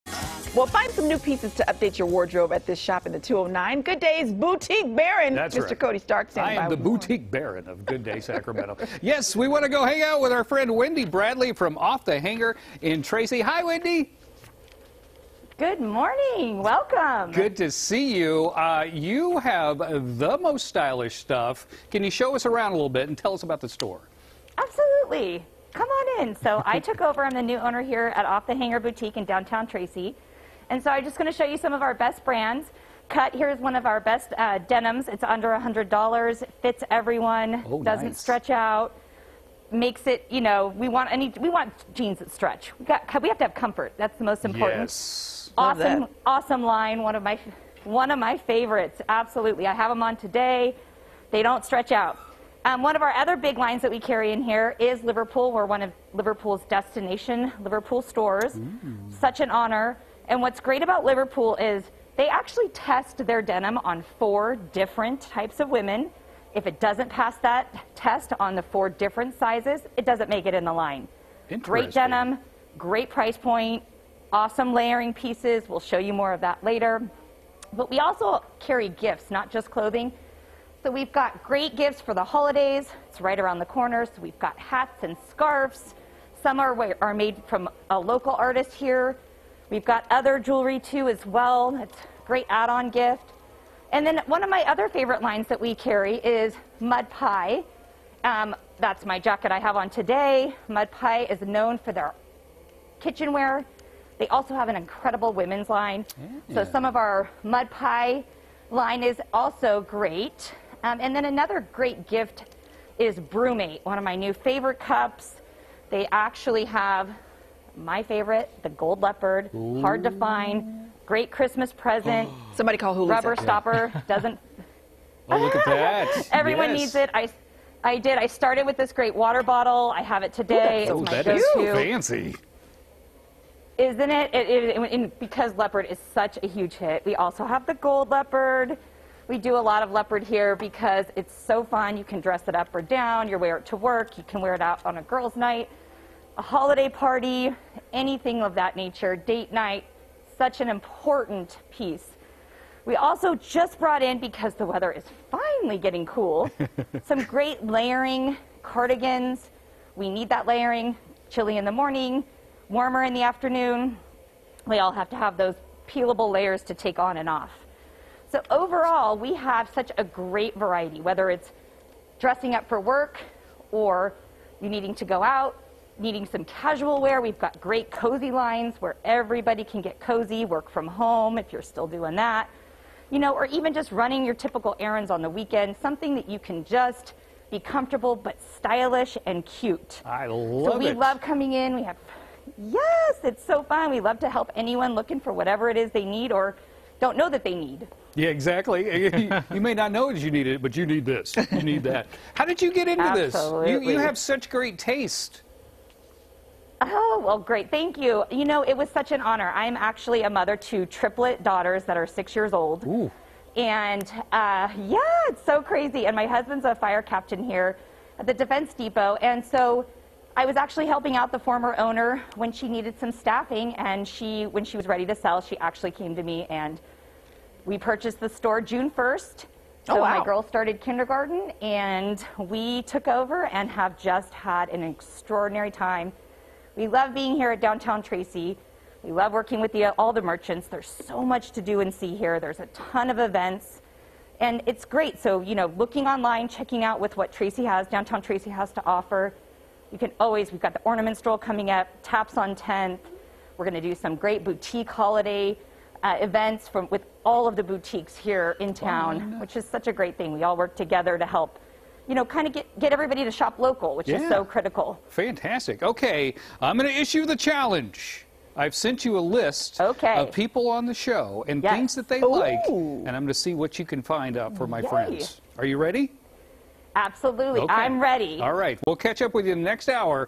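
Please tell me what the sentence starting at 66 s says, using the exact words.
If it doesn't pass that test on the four different sizes, it doesn't make it in the line.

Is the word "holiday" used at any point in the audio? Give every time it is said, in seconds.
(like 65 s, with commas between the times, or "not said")
82 s, 146 s, 254 s.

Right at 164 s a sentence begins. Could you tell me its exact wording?
We all have to have those peelable layers to take on and off.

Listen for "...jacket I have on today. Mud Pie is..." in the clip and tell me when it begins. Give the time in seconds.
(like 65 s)
99 s.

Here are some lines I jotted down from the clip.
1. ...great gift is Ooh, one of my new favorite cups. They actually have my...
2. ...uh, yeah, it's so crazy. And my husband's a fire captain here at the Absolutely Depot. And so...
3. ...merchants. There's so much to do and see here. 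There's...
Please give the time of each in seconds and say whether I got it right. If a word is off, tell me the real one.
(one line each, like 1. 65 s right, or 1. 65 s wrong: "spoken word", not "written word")
1. 111 s wrong: "BrüMate", not "Ooh"
2. 214 s wrong: "Defense", not "Absolutely"
3. 240 s right.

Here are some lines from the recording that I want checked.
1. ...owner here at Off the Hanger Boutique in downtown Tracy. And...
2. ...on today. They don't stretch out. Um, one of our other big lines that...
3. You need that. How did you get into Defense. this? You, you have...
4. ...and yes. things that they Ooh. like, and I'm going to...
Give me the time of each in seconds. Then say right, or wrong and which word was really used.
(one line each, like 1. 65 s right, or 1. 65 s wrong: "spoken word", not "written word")
1. 27 s right
2. 50 s right
3. 201 s wrong: "Absolutely", not "Defense"
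4. 271 s right.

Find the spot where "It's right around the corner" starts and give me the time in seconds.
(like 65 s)
83 s.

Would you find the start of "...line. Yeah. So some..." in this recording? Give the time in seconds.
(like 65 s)
105 s.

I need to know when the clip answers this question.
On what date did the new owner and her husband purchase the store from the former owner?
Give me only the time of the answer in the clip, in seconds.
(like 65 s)
228 s.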